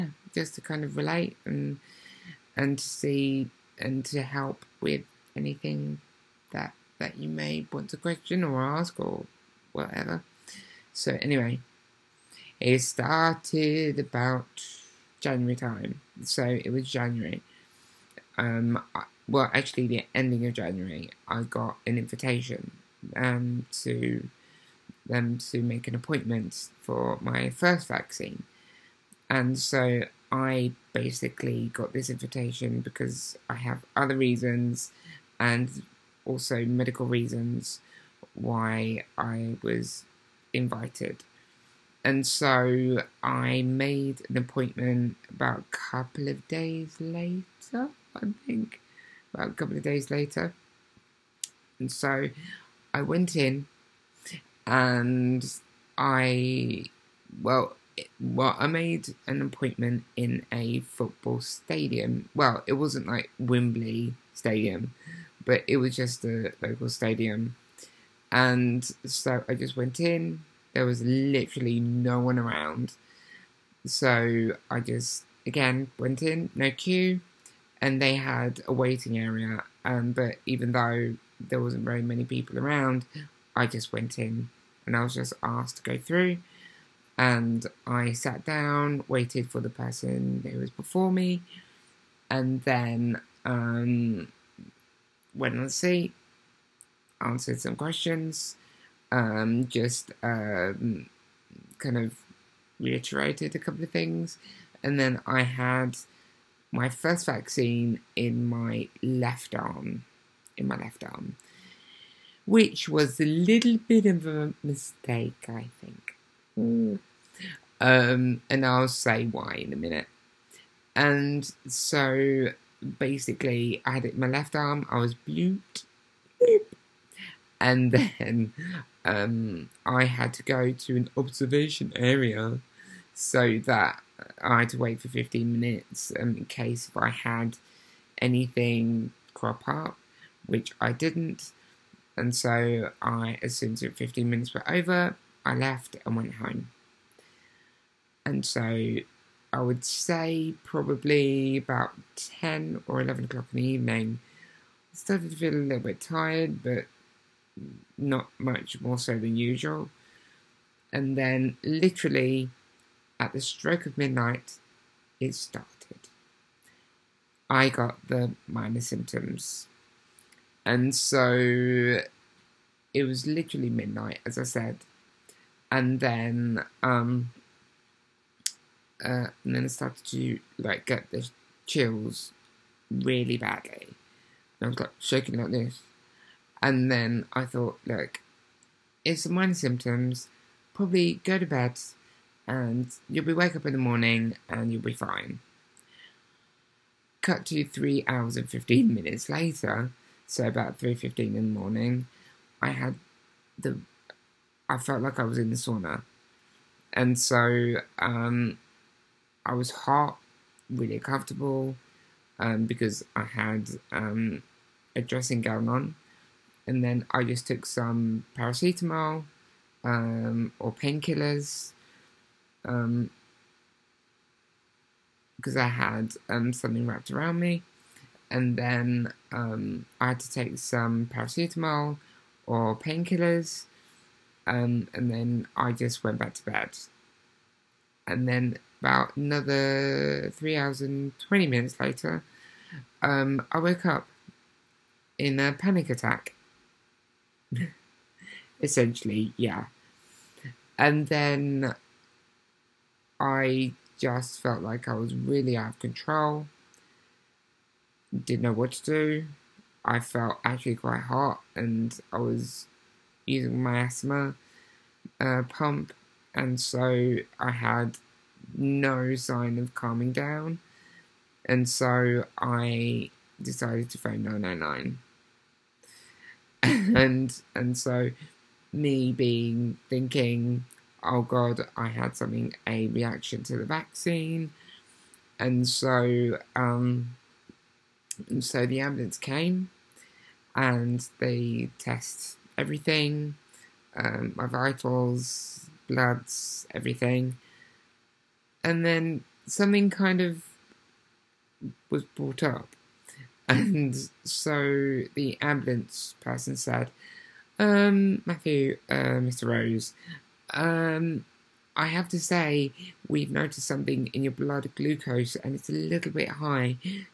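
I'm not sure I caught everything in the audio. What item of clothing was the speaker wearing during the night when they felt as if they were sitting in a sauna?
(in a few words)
Dressing gown.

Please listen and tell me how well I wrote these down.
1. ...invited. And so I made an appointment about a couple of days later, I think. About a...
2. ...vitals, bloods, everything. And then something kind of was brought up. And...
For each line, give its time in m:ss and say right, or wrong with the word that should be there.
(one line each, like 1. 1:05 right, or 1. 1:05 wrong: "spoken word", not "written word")
1. 0:40 right
2. 4:54 right.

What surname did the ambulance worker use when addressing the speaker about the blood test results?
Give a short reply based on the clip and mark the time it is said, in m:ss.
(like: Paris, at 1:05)
Rose, at 5:09.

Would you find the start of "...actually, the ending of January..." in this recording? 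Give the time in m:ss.
0:19.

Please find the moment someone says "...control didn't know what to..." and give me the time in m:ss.
4:15.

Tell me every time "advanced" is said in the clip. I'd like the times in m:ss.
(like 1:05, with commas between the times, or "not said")
not said.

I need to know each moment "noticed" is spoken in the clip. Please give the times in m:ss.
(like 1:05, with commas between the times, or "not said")
5:13.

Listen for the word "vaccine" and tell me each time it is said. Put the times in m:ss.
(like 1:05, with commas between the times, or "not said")
0:27, 1:47, 4:43.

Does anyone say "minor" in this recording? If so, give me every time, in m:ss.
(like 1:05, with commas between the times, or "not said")
2:48, 3:09.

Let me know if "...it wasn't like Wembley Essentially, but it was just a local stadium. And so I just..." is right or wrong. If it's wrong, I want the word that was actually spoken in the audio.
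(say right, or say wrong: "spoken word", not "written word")
wrong: "Stadium", not "Essentially".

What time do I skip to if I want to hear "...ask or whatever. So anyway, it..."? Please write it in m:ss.
0:08.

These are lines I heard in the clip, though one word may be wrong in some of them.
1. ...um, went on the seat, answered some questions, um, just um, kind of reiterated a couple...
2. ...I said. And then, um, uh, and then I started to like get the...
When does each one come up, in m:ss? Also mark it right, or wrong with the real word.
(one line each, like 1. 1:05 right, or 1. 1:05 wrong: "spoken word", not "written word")
1. 1:33 right
2. 2:54 right.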